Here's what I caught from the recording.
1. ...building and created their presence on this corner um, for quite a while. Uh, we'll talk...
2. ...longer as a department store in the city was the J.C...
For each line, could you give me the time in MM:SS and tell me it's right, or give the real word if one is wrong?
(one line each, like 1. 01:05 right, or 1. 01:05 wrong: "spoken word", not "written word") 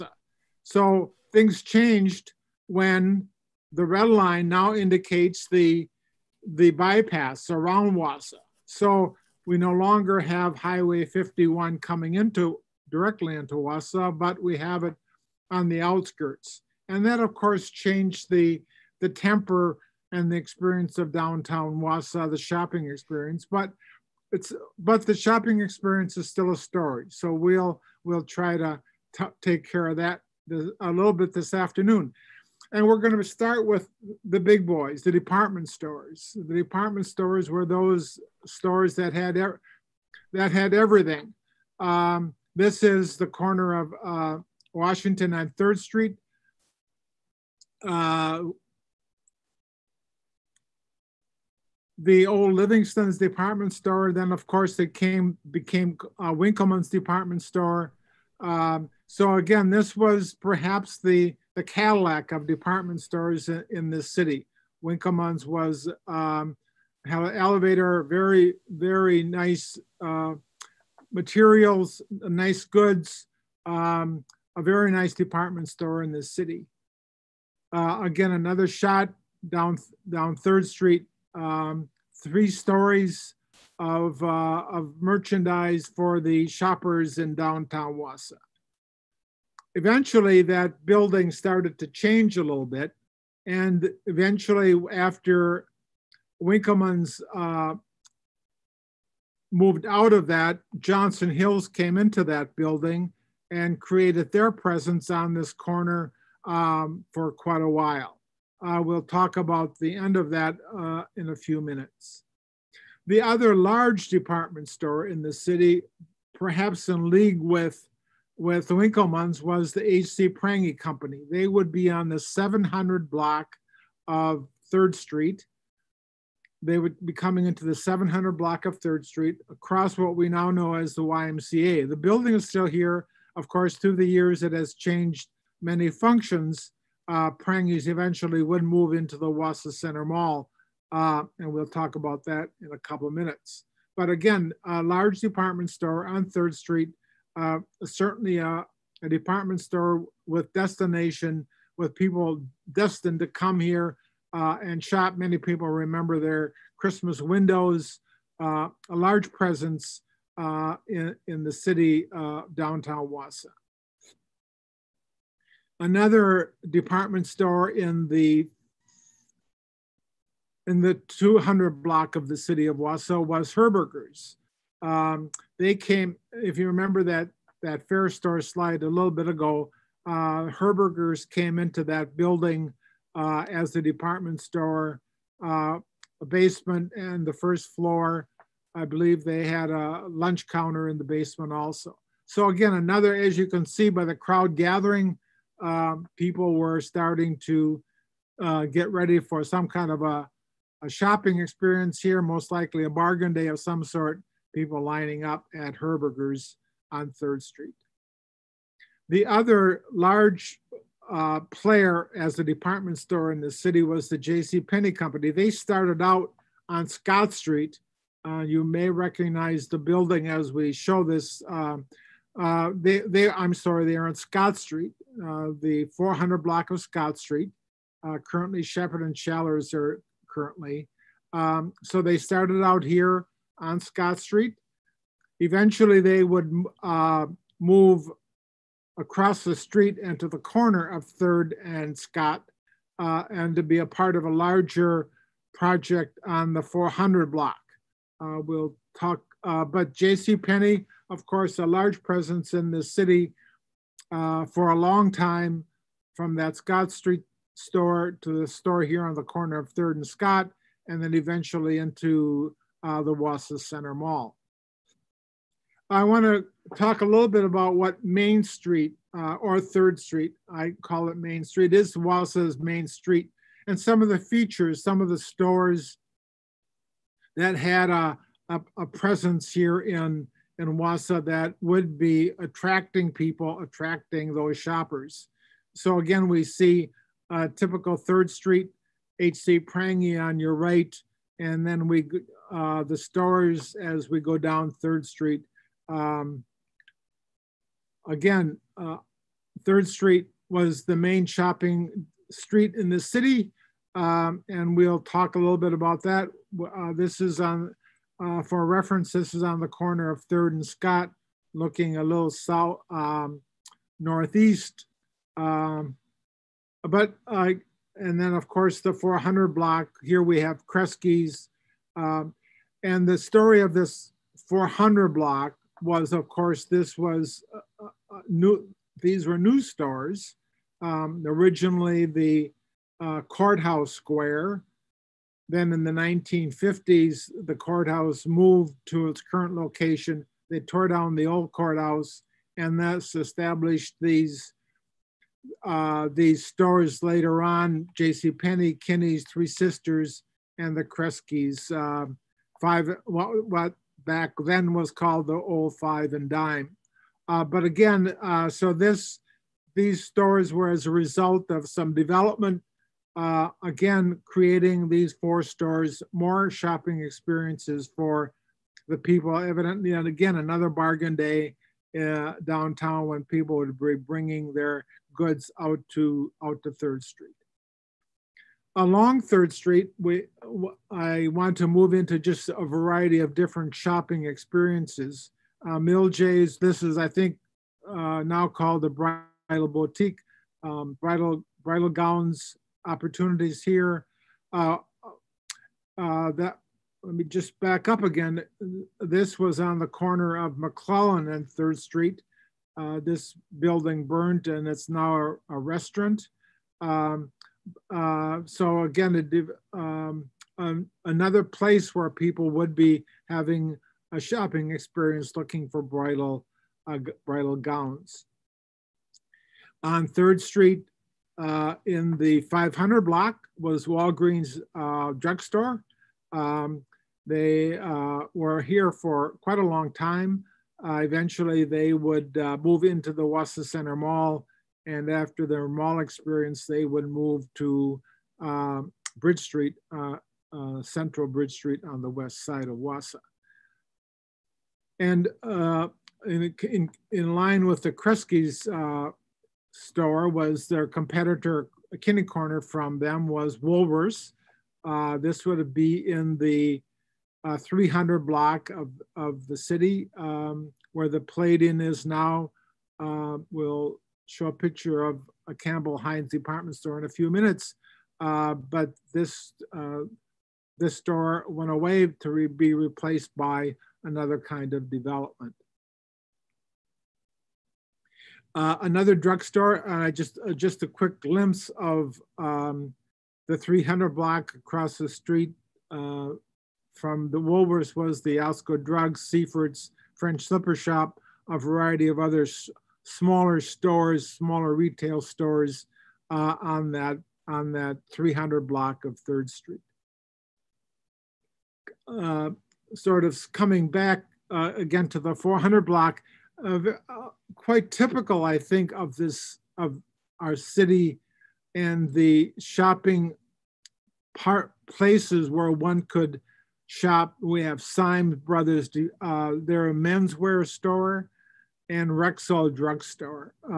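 1. 01:42 right
2. 03:31 wrong: "player", not "longer".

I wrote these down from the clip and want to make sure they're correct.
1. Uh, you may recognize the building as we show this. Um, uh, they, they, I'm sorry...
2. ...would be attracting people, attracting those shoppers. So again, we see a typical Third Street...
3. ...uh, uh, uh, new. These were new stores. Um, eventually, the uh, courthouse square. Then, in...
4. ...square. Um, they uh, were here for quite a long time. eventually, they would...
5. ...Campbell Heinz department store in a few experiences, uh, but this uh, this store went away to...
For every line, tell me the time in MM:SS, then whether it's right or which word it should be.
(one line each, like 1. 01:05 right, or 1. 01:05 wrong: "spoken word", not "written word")
1. 03:38 right
2. 04:41 right
3. 05:27 wrong: "originally", not "eventually"
4. 07:05 wrong: "drugstore", not "square"
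5. 07:45 wrong: "minutes", not "experiences".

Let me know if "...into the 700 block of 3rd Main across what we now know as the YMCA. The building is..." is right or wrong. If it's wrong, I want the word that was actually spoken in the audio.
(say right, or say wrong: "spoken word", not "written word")
wrong: "Street", not "Main".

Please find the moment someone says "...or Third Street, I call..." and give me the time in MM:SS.
04:29.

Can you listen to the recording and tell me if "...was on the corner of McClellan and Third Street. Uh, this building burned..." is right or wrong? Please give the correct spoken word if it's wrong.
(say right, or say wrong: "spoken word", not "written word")
right.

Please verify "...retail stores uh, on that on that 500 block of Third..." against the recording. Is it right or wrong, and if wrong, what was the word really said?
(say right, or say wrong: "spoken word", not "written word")
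wrong: "300", not "500".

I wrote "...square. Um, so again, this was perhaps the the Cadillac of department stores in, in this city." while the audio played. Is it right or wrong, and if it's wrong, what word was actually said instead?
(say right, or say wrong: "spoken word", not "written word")
wrong: "store", not "square".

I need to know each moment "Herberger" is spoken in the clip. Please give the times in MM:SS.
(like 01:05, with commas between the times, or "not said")
02:53, 03:00, 03:25.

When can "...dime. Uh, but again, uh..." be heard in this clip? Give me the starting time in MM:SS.
05:56.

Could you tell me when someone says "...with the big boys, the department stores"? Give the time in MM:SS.
00:33.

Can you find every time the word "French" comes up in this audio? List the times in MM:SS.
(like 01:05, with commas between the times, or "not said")
08:10.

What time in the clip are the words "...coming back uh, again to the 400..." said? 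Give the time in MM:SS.
08:23.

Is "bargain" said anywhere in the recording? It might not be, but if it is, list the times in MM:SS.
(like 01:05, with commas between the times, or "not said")
03:22, 06:10.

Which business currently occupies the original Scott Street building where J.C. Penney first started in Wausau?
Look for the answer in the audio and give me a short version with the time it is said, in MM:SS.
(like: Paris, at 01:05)
Shepherd and Schallers, at 03:48.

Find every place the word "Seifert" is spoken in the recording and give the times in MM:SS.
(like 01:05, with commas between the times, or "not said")
08:09.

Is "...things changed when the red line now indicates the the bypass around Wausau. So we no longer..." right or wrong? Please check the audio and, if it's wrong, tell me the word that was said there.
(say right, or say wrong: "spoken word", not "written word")
right.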